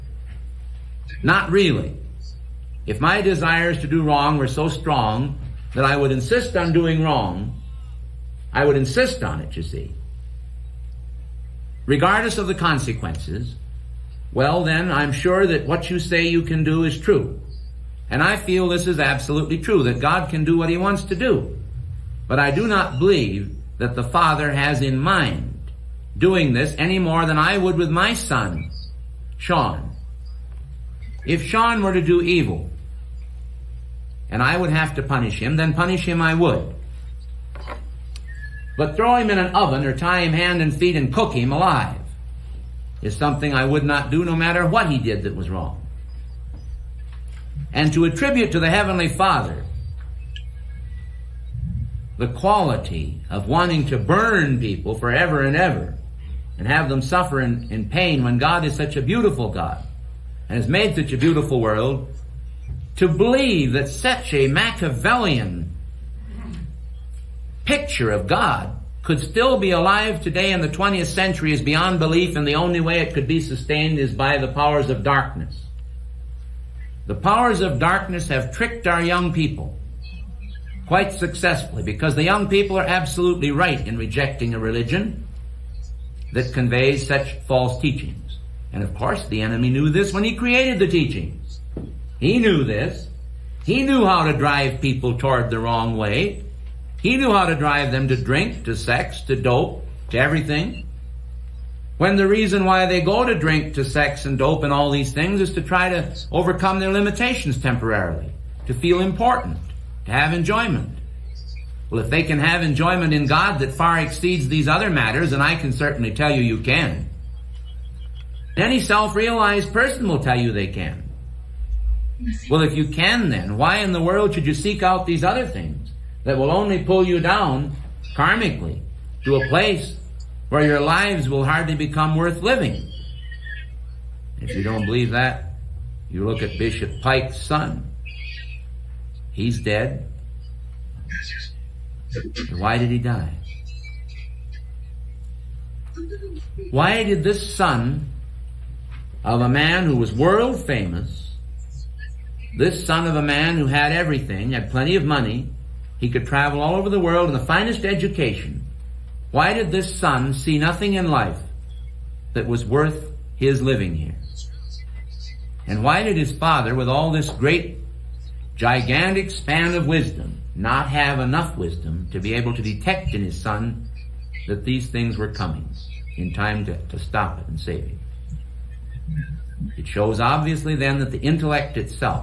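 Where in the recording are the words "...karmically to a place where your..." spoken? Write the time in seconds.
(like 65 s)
128 s.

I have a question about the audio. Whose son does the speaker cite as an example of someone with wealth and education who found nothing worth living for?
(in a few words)
Bishop Pike.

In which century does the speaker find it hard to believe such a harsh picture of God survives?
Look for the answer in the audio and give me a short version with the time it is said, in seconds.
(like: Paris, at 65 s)
20th century, at 70 s.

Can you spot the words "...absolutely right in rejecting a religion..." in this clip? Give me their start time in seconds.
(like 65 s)
82 s.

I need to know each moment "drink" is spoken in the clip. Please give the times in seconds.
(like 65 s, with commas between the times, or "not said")
98 s, 103 s.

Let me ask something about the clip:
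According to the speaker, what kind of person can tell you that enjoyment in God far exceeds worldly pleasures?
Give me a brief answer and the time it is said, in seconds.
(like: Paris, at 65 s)
Self-realized person, at 118 s.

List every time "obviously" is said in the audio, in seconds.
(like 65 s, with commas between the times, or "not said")
180 s.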